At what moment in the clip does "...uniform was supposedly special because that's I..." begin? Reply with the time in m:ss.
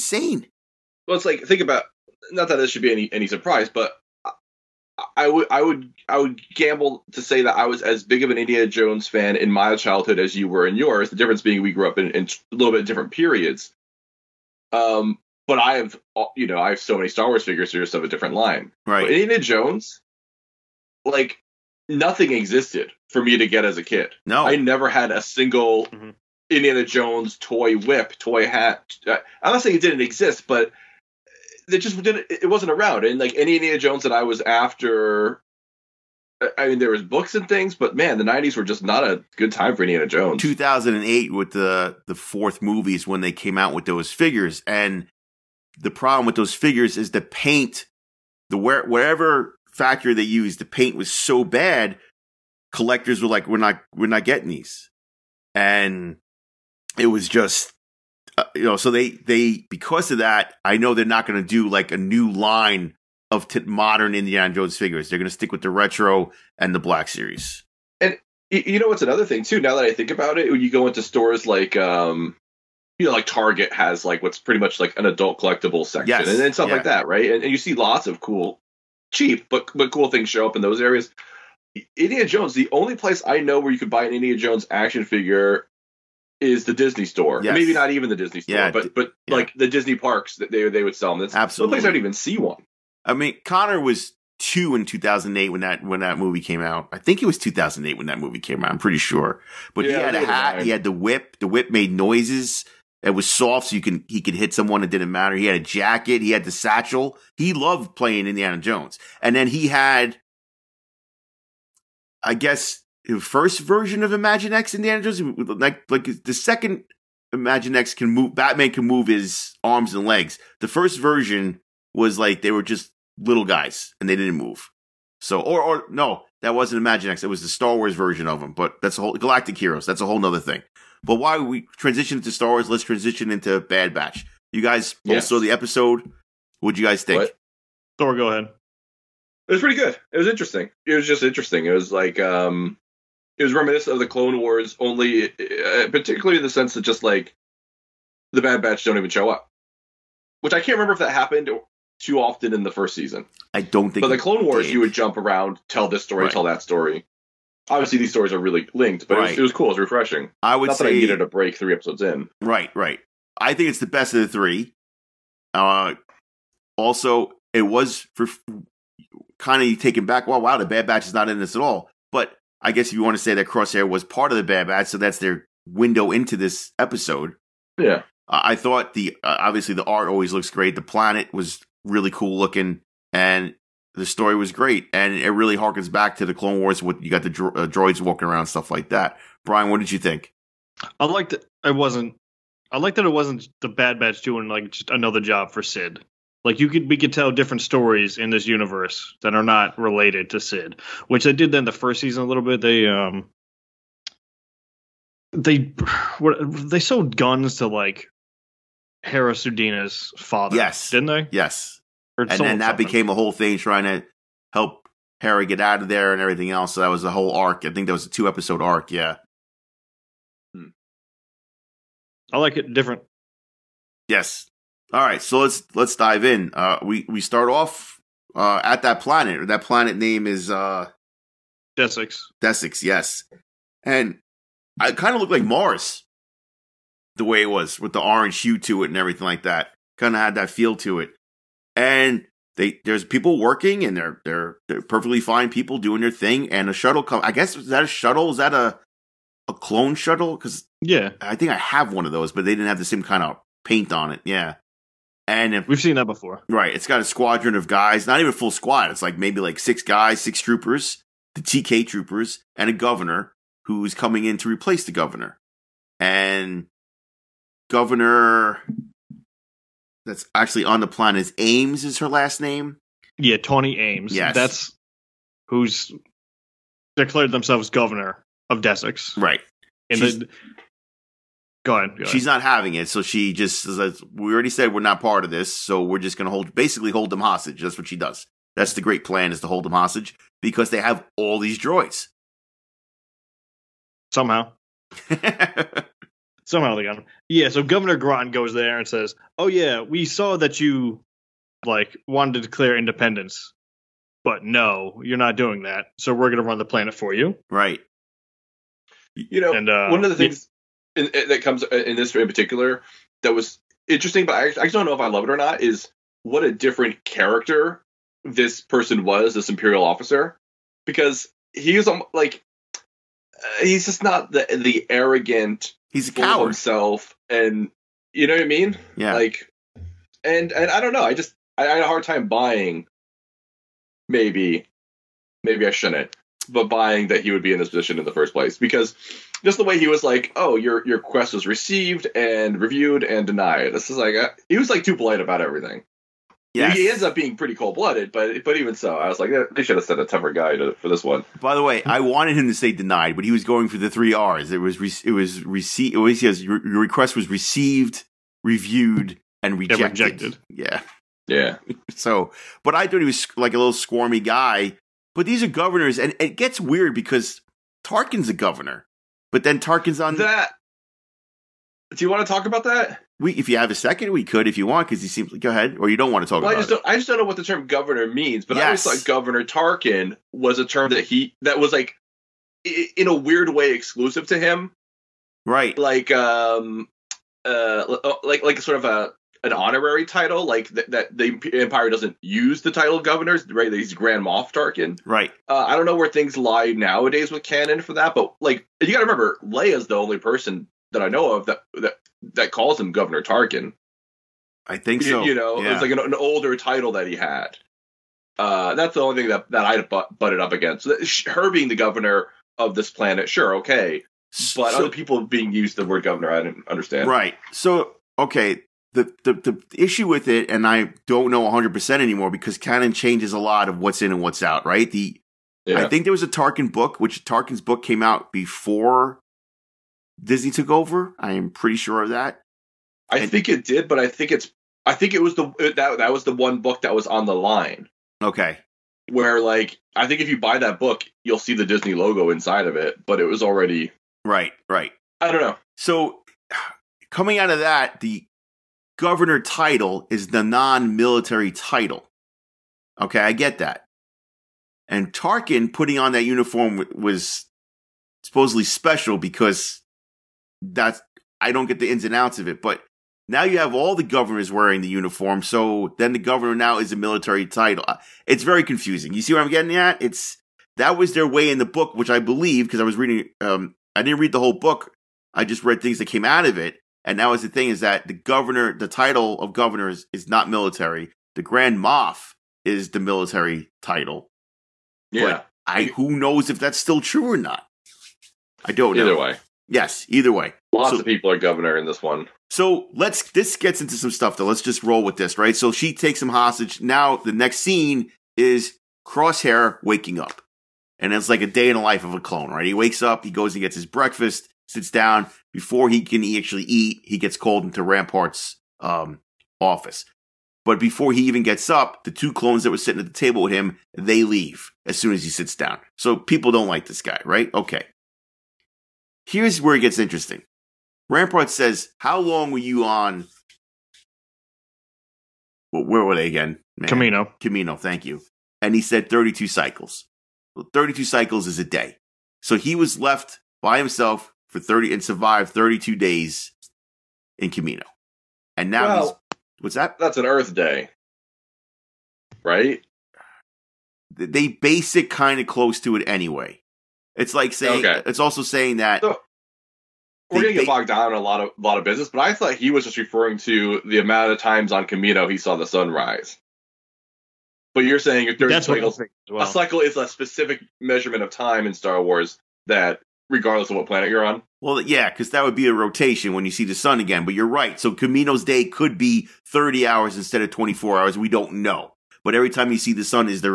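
7:36.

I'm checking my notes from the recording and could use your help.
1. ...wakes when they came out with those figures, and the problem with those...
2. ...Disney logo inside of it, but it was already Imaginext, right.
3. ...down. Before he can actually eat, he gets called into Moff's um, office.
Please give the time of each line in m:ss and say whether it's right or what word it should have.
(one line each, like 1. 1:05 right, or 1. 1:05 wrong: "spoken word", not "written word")
1. 0:42 wrong: "movies", not "wakes"
2. 7:21 wrong: "Right", not "Imaginext"
3. 8:24 wrong: "Rampart", not "Moff".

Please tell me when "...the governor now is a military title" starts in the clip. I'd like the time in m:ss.
7:46.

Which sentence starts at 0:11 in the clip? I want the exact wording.
The difference being we grew up in, in a little bit different periods.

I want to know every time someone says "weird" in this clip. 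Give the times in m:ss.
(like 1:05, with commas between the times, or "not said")
6:06, 6:23.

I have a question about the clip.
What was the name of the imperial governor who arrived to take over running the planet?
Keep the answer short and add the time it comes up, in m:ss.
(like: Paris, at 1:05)
Groton, at 4:57.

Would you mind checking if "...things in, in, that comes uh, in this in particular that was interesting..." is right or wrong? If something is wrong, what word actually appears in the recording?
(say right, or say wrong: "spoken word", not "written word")
right.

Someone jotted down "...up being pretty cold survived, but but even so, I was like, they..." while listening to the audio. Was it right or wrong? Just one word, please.
wrong.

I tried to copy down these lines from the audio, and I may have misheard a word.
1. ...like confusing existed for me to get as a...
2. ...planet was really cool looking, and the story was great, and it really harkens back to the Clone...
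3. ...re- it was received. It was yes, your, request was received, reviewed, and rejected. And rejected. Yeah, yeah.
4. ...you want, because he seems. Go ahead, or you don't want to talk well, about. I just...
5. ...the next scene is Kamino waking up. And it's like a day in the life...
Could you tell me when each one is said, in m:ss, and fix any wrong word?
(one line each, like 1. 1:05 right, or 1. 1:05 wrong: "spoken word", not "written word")
1. 0:21 wrong: "nothing", not "confusing"
2. 3:00 right
3. 5:54 right
4. 6:14 right
5. 8:17 wrong: "Crosshair", not "Kamino".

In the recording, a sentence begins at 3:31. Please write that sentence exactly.
Yes, and then that became a whole thing trying to help Harry get out of there and everything else.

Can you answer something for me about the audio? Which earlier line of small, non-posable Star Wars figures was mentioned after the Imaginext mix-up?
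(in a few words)
Galactic Heroes.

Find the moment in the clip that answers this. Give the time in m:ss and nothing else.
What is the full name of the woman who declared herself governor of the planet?
4:33.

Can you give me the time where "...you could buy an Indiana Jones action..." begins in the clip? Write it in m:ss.
1:23.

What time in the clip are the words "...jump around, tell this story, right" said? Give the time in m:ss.
2:34.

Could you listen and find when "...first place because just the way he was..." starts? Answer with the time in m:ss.
5:38.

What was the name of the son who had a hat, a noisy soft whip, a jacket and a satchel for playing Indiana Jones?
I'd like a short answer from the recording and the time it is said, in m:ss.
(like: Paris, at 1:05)
Connor, at 1:33.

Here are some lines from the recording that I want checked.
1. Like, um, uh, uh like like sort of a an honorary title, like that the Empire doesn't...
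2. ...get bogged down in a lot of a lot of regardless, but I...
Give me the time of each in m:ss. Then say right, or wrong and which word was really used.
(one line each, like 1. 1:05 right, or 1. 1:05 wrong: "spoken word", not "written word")
1. 6:25 right
2. 9:10 wrong: "business", not "regardless".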